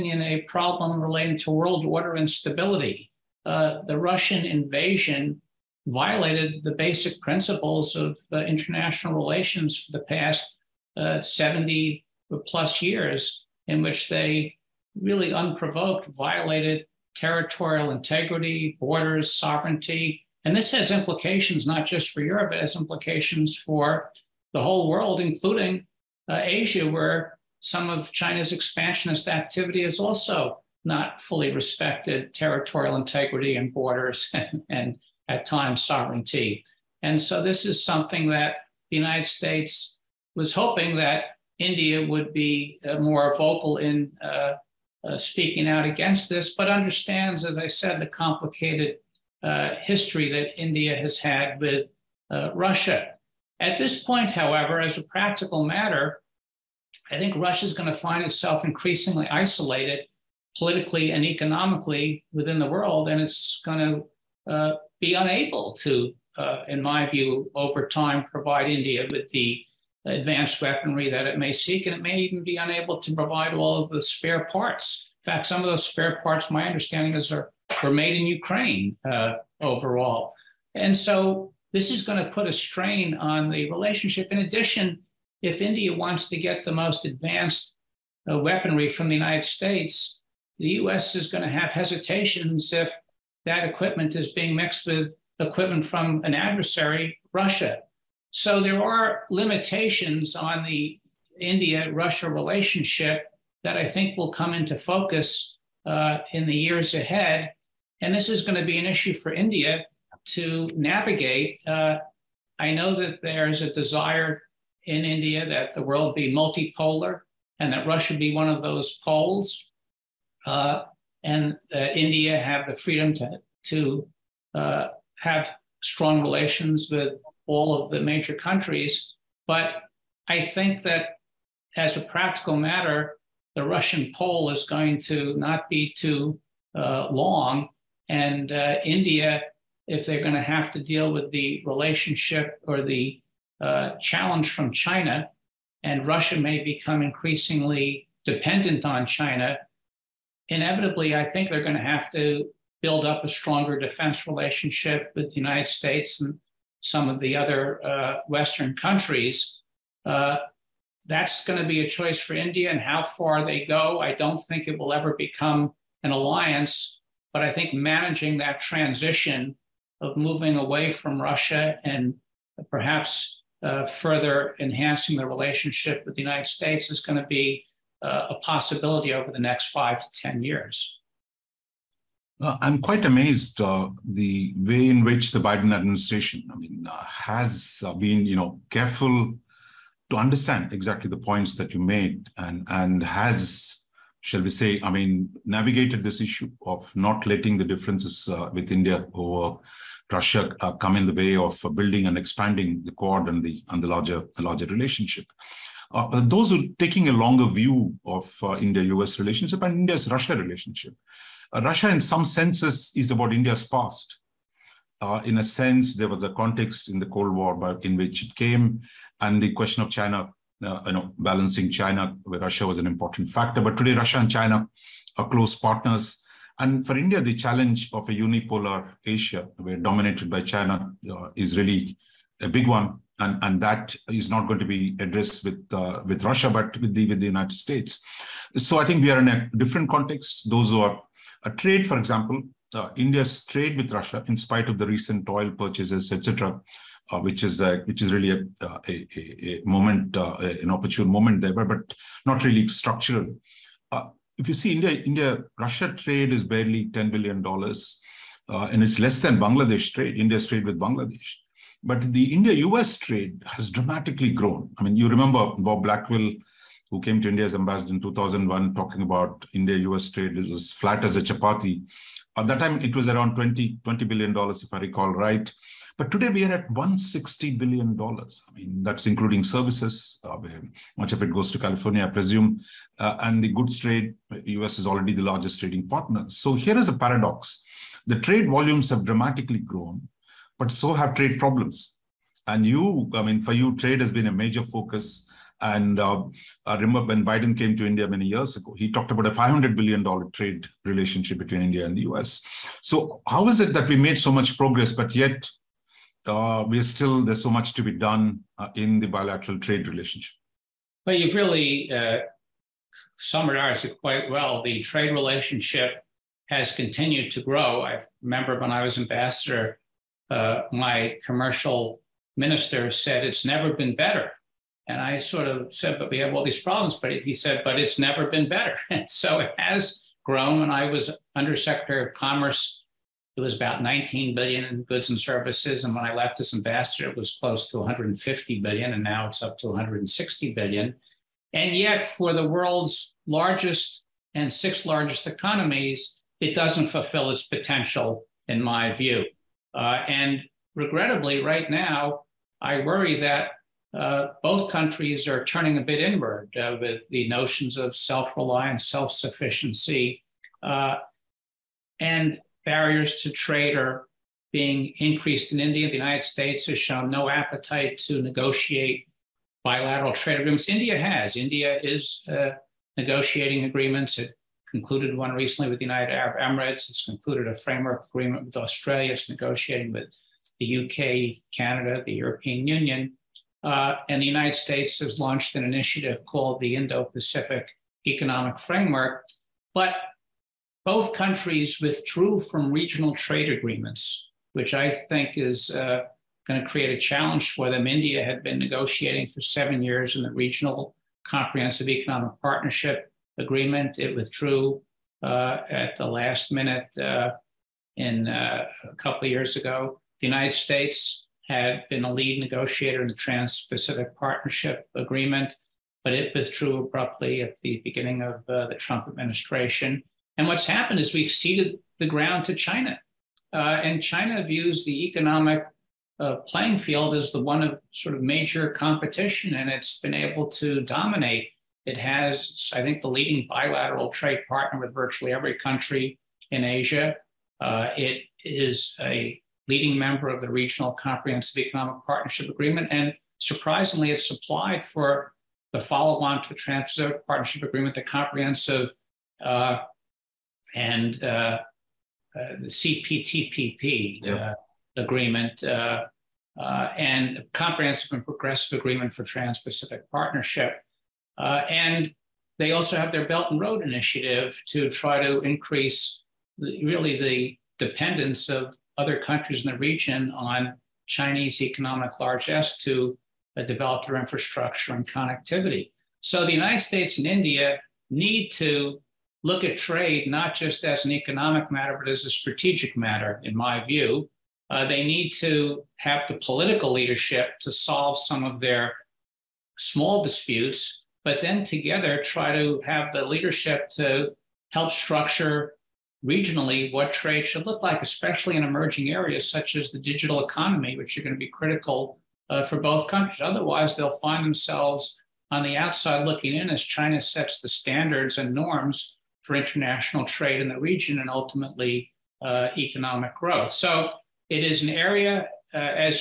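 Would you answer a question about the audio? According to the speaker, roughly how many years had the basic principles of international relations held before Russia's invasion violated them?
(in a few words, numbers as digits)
70 plus years.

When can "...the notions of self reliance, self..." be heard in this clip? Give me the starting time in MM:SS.
05:57.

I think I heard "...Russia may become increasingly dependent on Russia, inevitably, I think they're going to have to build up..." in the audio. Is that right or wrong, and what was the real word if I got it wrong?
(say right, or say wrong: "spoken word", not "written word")
wrong: "China", not "Russia".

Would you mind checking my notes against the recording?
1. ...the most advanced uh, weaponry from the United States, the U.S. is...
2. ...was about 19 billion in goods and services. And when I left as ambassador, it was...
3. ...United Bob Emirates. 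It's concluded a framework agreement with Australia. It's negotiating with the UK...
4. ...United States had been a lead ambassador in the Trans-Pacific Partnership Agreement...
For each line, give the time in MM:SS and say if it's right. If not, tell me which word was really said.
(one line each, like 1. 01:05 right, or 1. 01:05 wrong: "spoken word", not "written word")
1. 01:26 right
2. 05:33 right
3. 06:15 wrong: "Arab", not "Bob"
4. 06:50 wrong: "negotiator", not "ambassador".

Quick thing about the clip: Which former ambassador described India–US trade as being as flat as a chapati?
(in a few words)
Bob Blackwill.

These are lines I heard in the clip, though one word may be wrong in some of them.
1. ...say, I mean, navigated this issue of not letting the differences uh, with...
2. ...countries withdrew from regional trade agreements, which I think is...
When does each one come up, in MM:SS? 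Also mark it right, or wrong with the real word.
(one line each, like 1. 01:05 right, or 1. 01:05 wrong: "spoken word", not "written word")
1. 03:14 right
2. 06:31 right.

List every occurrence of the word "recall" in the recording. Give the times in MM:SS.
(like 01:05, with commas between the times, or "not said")
04:34.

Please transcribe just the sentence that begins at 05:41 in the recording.
And yet, for the world's largest and sixth largest economies, it doesn't fulfill its potential, in my view.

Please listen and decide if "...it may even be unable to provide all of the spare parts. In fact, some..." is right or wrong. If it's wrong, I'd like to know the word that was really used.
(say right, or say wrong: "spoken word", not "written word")
right.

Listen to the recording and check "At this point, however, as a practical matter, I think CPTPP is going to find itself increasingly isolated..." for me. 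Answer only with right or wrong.
wrong.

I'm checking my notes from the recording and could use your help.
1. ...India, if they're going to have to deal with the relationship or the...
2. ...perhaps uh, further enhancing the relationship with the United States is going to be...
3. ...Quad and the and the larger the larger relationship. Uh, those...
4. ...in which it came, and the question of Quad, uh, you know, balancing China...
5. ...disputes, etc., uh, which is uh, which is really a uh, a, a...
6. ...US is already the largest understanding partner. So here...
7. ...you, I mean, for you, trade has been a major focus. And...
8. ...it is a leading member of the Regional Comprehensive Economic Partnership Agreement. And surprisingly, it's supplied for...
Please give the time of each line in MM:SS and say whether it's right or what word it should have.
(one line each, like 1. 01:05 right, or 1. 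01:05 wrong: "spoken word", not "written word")
1. 02:18 right
2. 02:52 right
3. 03:22 right
4. 03:37 wrong: "China", not "Quad"
5. 04:05 wrong: "purchases", not "disputes"
6. 04:44 wrong: "trading", not "understanding"
7. 04:52 right
8. 07:17 right.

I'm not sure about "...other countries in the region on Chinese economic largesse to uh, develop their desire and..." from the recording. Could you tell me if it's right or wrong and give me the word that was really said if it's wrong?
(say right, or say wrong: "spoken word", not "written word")
wrong: "infrastructure", not "desire".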